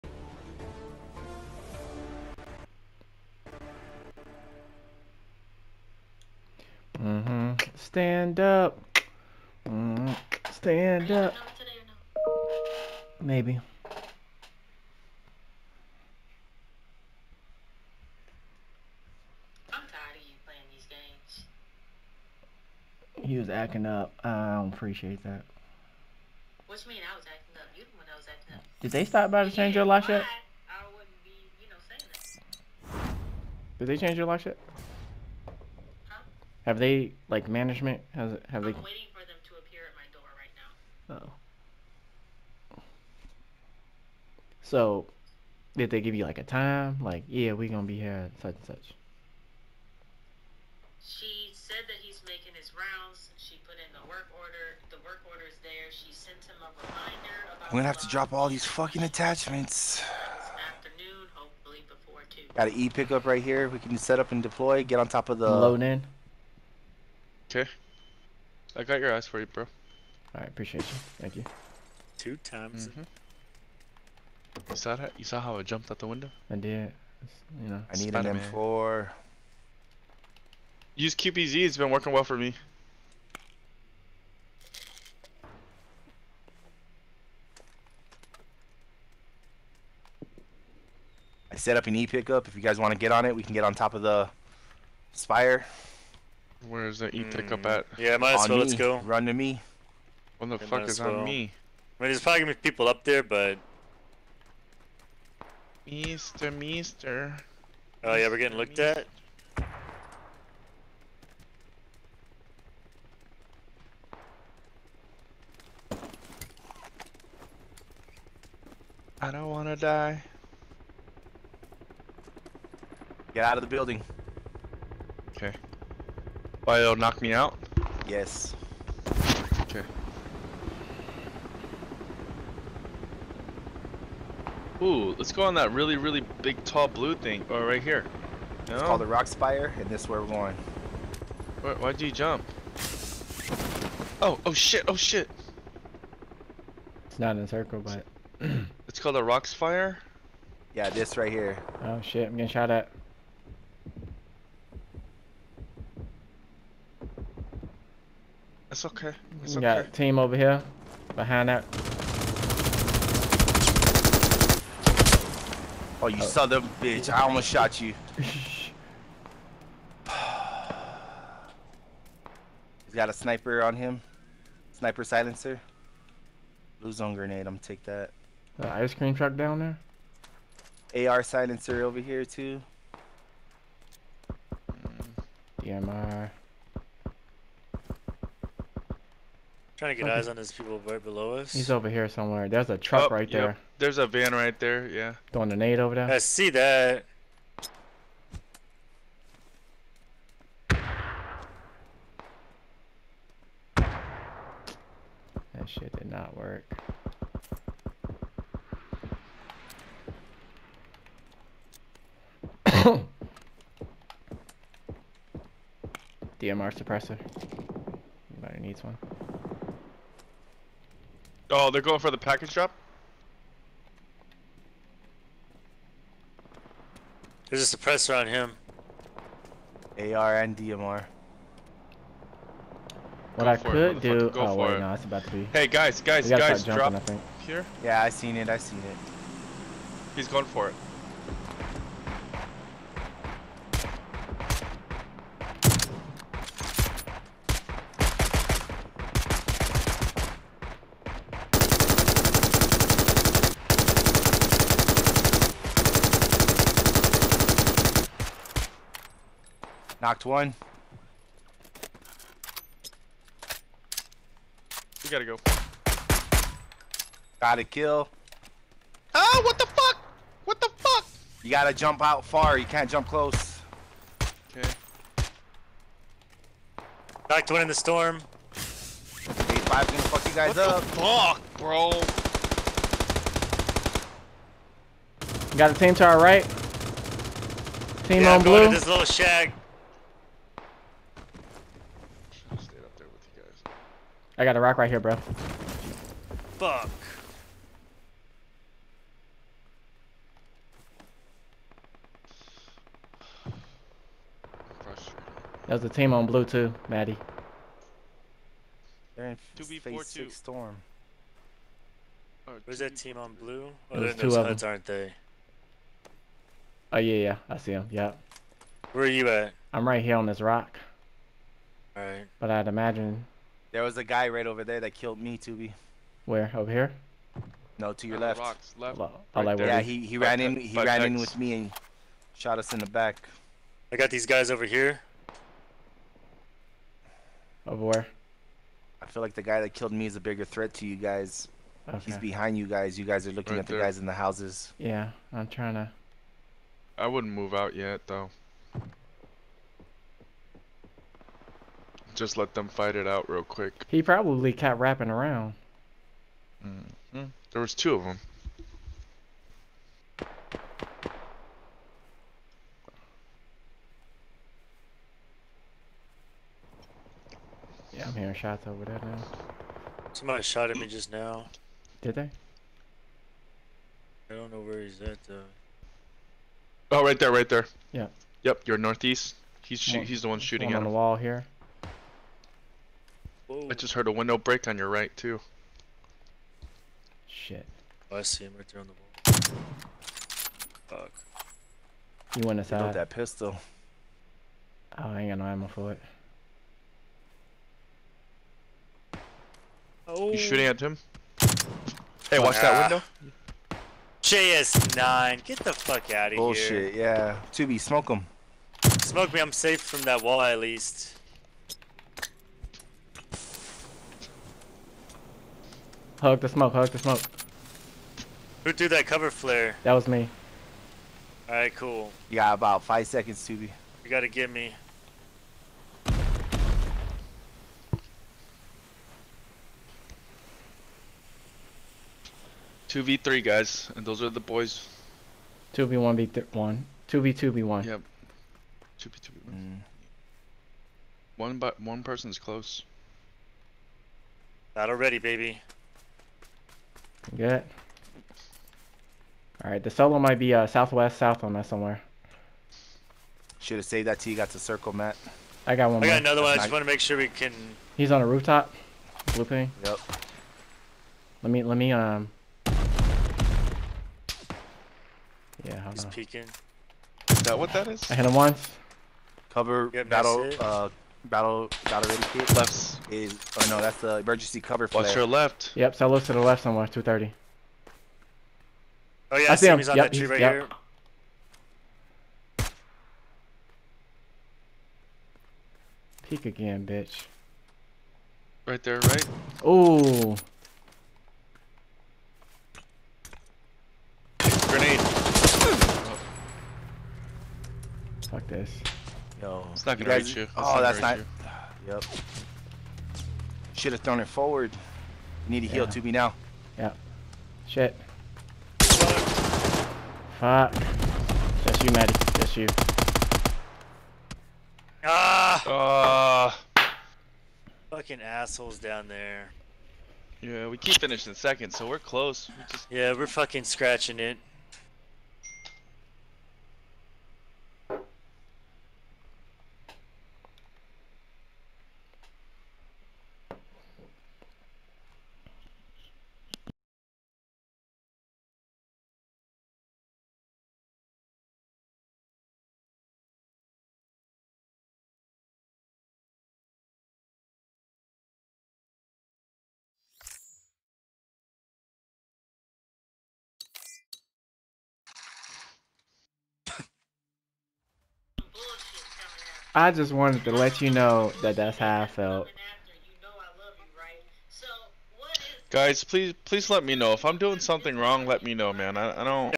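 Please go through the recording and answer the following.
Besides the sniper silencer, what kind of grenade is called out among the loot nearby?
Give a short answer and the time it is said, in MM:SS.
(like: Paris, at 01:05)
Blue zone grenade, at 02:56.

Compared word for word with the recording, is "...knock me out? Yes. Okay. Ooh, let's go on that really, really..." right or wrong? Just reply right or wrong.
right.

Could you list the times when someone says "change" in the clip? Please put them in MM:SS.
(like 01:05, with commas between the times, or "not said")
00:29, 00:33.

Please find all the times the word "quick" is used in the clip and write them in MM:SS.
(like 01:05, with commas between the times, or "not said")
05:53.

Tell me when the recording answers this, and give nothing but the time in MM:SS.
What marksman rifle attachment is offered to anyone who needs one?
03:36.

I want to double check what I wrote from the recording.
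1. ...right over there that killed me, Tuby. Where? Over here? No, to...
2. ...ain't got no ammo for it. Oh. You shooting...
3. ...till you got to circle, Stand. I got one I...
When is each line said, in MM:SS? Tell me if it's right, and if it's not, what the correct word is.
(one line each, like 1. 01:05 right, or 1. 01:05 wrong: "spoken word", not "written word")
1. 05:24 right
2. 06:35 right
3. 07:34 wrong: "Matt", not "Stand".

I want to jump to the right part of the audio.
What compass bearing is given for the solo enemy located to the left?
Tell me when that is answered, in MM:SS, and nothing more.
07:56.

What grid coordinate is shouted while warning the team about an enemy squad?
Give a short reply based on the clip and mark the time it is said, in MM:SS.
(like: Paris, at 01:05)
A5, at 04:38.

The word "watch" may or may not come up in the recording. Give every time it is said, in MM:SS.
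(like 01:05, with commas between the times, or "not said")
06:42, 07:55.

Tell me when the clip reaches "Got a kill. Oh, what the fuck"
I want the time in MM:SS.
04:27.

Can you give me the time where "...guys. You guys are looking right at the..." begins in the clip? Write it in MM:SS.
05:42.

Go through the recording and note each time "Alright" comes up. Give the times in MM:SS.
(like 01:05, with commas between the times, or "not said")
05:21, 07:01, 07:29.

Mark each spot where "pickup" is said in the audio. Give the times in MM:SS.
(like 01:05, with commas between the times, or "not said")
01:02, 01:32.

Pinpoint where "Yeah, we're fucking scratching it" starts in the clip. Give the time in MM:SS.
08:42.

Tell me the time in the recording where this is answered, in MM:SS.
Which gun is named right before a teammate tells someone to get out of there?
06:44.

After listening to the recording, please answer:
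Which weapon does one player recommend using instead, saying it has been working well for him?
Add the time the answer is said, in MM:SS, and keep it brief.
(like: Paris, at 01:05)
QBZ, at 01:21.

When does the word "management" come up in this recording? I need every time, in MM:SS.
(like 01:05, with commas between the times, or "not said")
00:37.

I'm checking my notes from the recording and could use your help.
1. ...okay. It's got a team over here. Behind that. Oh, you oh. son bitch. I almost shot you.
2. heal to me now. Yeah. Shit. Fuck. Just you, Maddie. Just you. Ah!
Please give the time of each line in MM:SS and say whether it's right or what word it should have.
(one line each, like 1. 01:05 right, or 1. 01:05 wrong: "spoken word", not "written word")
1. 02:38 right
2. 08:25 right.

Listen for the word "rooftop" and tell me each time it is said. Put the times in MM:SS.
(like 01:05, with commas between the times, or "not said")
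07:38.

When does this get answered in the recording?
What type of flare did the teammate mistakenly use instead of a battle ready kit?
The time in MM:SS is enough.
07:54.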